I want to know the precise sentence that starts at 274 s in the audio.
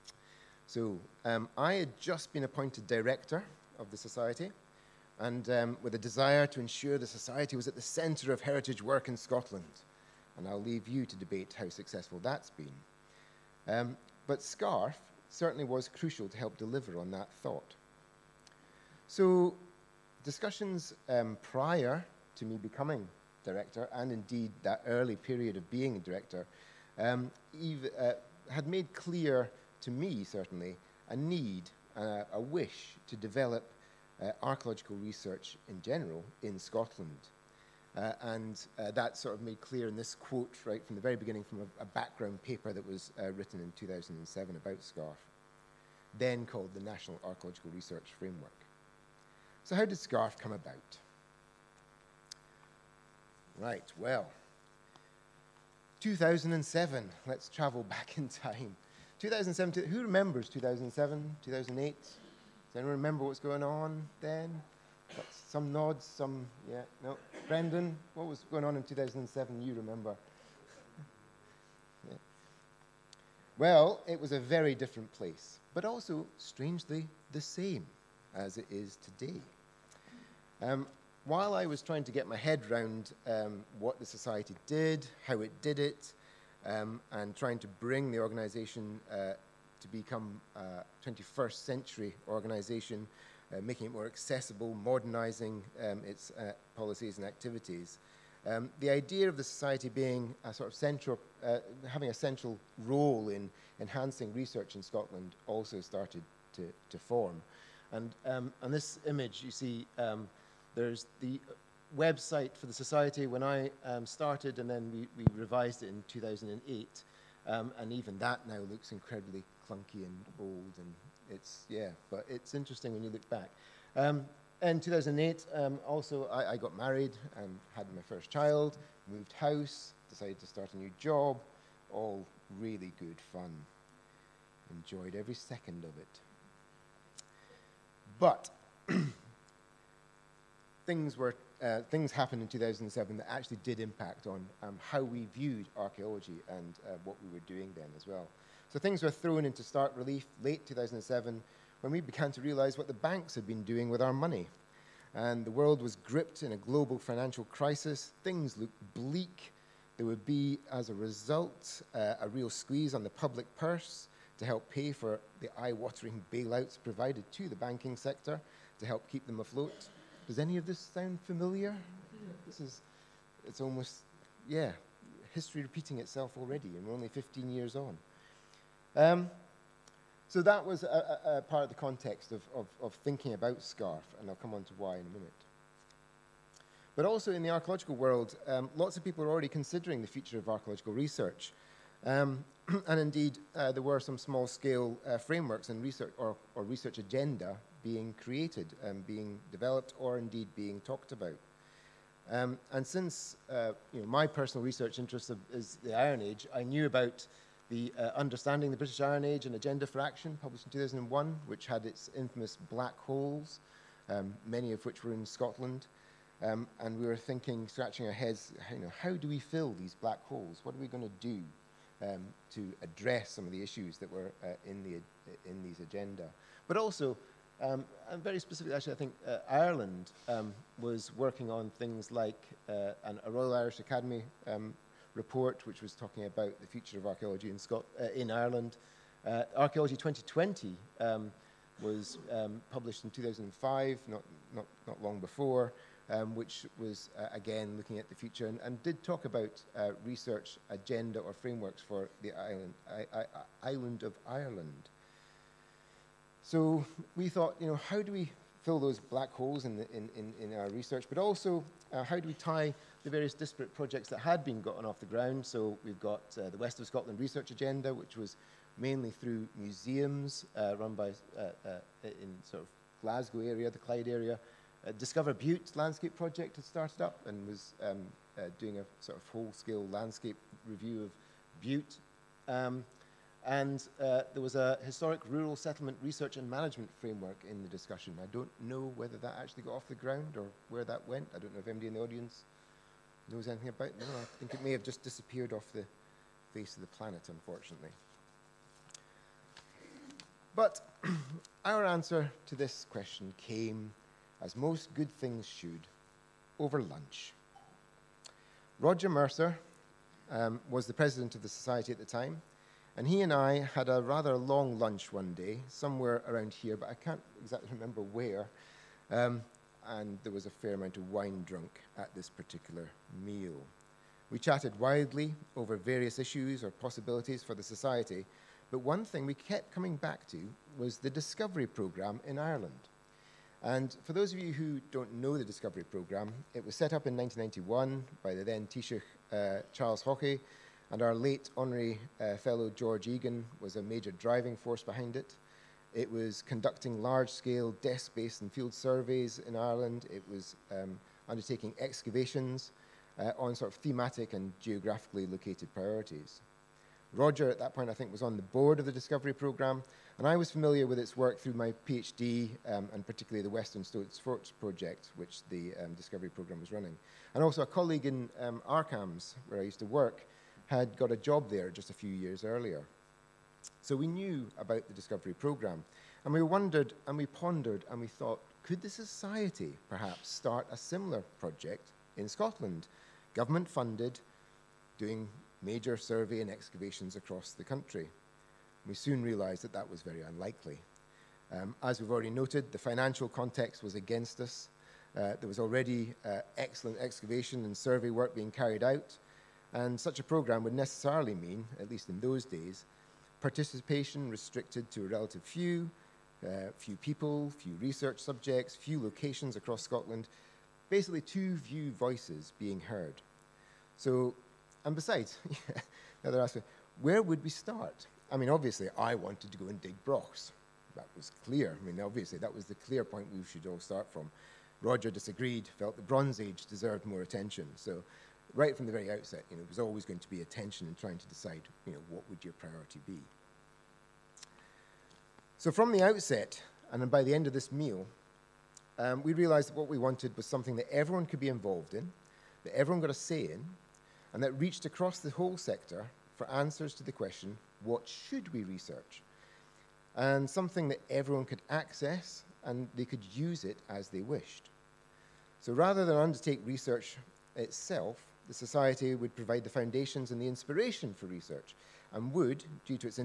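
Uh, Discover Bute landscape project had started up and was um, doing a sort of whole-scale landscape review of Bute.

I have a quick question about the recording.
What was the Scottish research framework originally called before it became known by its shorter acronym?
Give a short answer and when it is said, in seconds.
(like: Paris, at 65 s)
National Archaeological Research Framework, at 46 s.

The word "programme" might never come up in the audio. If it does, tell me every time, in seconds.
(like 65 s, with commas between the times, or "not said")
331 s, 335 s, 359 s, 366 s, 375 s, 400 s.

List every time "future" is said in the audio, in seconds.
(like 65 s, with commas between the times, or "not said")
190 s, 236 s, 248 s.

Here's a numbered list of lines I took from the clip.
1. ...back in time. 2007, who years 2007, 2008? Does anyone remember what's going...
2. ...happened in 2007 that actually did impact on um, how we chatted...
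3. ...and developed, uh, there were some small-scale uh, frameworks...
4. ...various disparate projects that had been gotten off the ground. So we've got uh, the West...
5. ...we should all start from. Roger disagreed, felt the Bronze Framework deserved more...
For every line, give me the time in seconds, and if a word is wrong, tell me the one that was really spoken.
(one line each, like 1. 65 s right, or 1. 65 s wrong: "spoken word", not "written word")
1. 57 s wrong: "remembers", not "years"
2. 142 s wrong: "viewed", not "chatted"
3. 192 s wrong: "indeed", not "developed"
4. 263 s right
5. 423 s wrong: "Age", not "Framework".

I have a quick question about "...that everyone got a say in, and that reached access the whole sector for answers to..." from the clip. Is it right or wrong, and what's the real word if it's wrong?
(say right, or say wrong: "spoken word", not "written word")
wrong: "across", not "access".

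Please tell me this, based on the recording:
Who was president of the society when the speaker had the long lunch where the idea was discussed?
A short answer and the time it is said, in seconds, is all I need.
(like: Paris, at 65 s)
Roger Mercer, at 308 s.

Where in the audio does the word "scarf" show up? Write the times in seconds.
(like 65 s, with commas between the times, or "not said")
14 s, 44 s, 49 s, 183 s.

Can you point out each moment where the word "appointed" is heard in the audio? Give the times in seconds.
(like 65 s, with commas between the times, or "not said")
2 s.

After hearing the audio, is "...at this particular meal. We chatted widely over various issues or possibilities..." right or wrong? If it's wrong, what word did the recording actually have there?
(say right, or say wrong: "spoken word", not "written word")
right.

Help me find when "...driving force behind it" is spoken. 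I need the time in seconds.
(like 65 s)
344 s.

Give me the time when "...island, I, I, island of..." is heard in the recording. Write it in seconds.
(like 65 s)
252 s.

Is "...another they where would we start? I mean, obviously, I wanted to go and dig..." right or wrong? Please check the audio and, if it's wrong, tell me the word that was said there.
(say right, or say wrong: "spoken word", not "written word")
right.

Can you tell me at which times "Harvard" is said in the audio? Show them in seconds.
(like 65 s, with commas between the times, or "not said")
not said.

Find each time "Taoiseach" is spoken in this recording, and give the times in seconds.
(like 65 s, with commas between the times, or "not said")
338 s.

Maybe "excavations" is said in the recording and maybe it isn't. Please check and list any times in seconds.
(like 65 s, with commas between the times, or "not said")
351 s, 386 s, 396 s.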